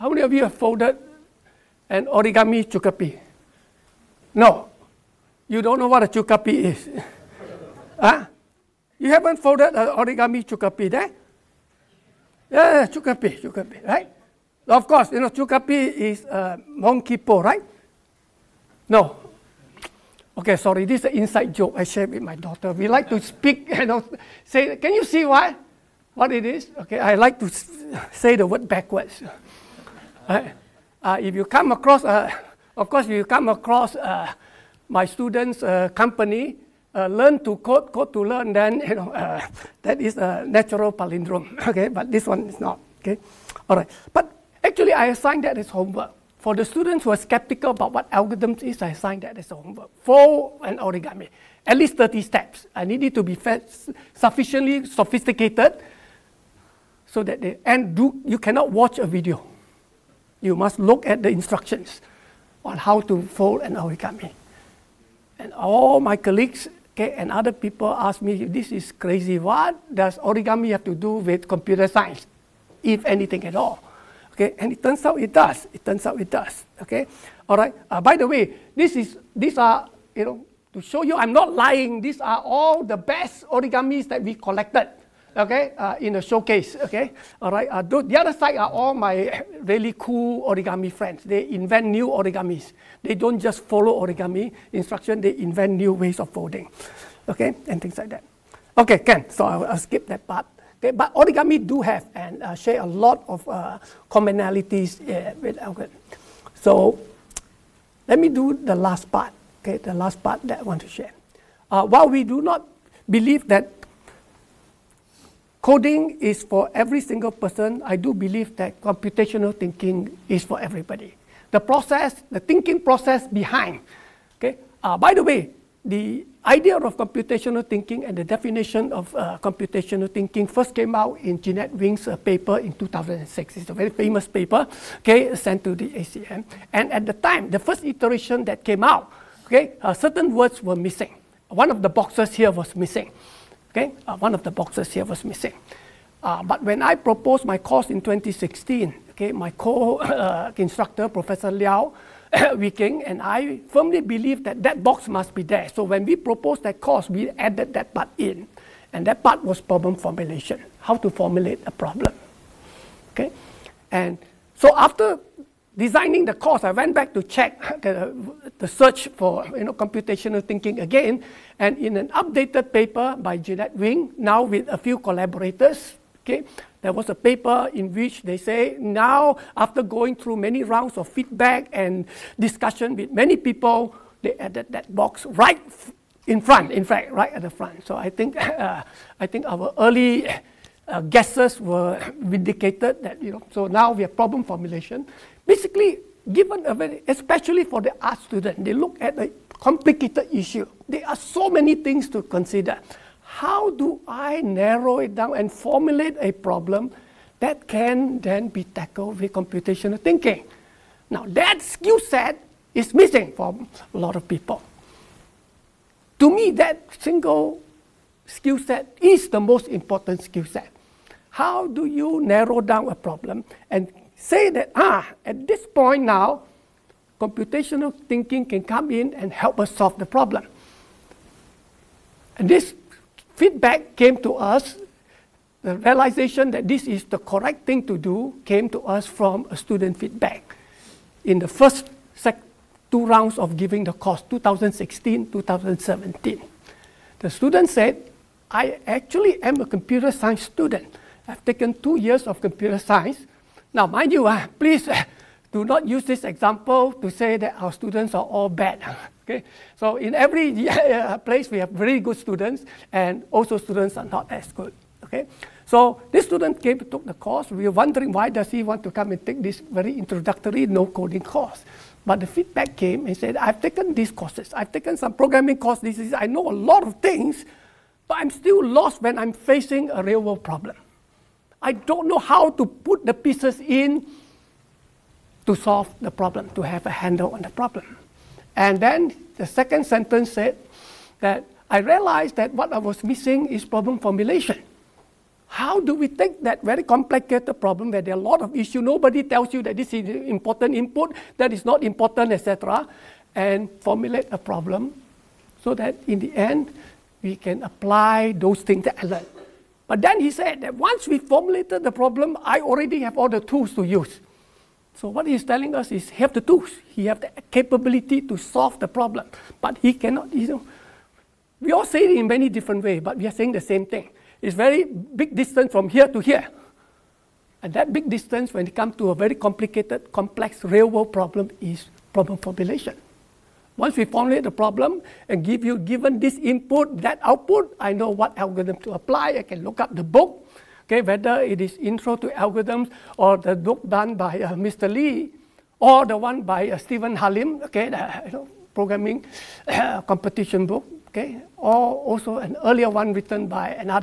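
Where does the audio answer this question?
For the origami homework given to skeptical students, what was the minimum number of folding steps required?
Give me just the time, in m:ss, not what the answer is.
0:51.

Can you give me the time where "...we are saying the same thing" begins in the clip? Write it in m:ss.
5:23.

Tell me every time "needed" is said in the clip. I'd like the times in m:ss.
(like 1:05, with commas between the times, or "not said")
0:52.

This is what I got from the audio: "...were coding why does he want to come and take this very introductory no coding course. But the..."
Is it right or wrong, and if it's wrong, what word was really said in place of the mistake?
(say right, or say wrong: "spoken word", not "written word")
wrong: "wondering", not "coding".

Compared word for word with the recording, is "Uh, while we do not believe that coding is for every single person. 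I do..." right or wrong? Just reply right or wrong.
right.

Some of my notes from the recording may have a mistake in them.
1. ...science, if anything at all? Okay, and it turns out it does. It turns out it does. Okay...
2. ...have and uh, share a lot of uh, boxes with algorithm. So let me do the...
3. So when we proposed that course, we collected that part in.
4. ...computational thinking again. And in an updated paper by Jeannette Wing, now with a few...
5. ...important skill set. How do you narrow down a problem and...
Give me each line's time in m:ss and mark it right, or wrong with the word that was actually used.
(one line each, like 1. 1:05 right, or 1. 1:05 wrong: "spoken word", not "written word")
1. 1:11 right
2. 1:41 wrong: "commonalities", not "boxes"
3. 2:35 wrong: "added", not "collected"
4. 2:49 right
5. 3:39 right.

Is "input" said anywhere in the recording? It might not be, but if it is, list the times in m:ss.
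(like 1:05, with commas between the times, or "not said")
5:00, 5:36.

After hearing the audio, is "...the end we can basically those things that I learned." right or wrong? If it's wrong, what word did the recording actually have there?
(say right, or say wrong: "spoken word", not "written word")
wrong: "apply", not "basically".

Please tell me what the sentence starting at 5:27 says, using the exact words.
And that big distance when it comes to a very complicated, complex real world problem is problem formulation.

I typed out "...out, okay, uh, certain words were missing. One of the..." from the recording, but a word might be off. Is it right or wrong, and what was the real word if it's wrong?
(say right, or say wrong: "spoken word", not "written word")
right.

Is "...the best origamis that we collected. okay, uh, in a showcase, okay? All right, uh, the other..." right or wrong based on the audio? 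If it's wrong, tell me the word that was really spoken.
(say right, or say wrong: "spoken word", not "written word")
right.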